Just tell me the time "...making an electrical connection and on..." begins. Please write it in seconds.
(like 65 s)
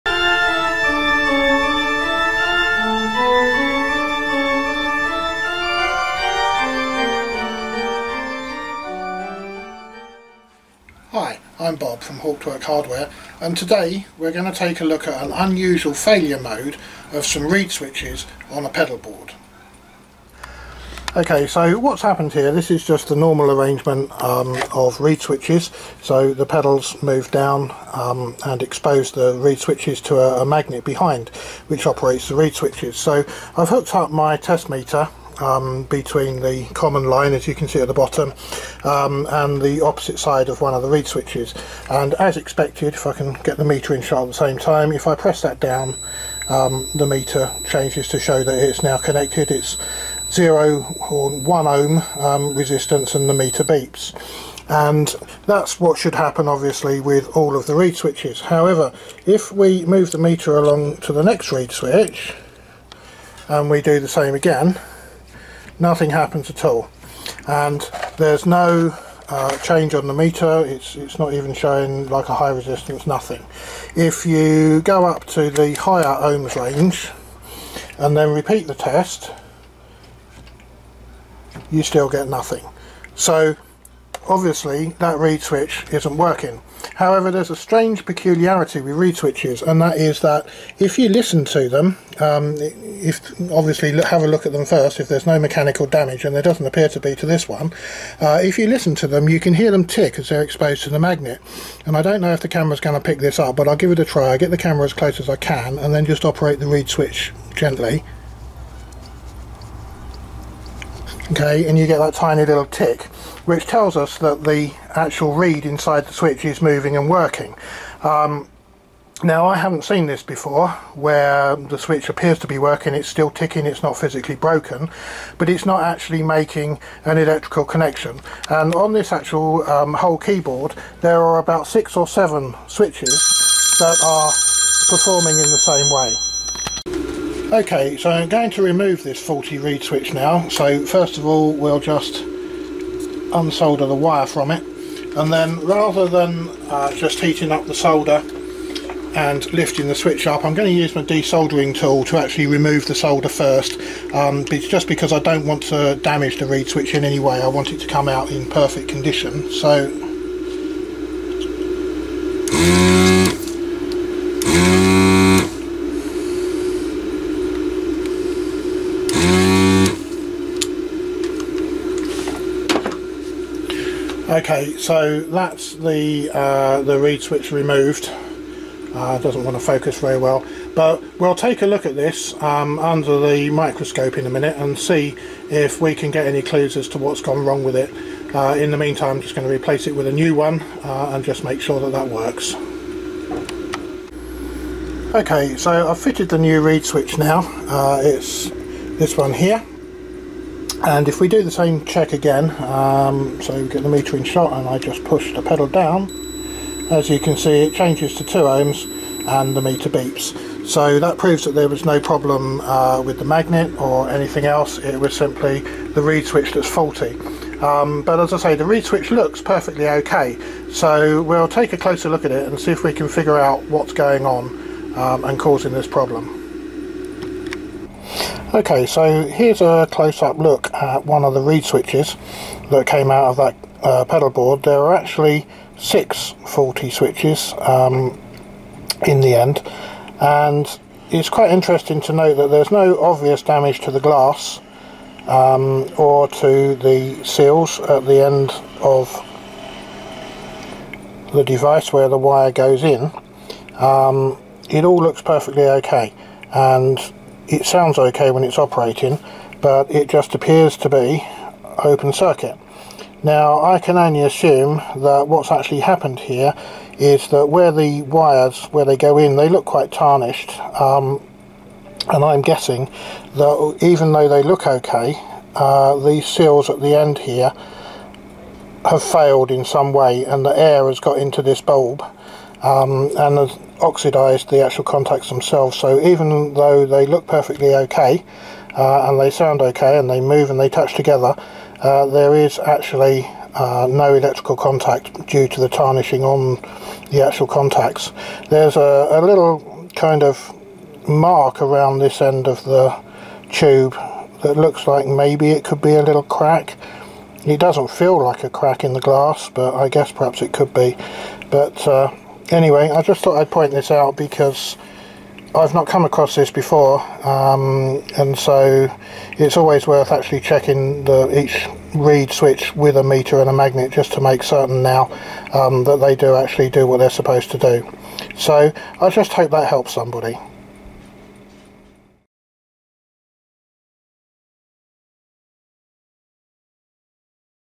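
126 s.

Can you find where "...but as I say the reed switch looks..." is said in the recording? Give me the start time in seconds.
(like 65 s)
218 s.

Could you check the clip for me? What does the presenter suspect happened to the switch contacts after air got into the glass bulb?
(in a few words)
oxidized.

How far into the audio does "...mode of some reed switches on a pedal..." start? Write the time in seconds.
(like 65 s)
16 s.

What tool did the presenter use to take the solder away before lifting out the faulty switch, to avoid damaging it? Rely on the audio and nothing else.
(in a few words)
desoldering tool.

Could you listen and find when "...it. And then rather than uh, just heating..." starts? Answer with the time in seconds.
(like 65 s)
144 s.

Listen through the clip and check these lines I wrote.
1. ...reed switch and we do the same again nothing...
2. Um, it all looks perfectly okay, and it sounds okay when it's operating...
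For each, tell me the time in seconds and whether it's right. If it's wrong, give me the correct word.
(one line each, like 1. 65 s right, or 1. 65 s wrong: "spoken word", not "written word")
1. 61 s right
2. 253 s right.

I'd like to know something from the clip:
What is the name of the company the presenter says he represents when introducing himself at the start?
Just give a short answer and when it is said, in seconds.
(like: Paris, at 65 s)
Hauptwerk Hardware, at 12 s.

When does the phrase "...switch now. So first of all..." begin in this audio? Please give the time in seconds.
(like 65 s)
139 s.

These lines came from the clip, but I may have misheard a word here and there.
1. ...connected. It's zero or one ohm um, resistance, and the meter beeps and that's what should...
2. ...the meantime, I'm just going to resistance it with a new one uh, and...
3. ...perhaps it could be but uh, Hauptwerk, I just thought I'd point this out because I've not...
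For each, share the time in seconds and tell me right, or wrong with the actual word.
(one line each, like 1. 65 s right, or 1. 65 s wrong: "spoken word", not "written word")
1. 48 s right
2. 188 s wrong: "replace", not "resistance"
3. 310 s wrong: "Anyway", not "Hauptwerk".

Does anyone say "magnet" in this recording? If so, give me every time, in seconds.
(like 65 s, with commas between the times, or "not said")
30 s, 100 s, 213 s, 323 s.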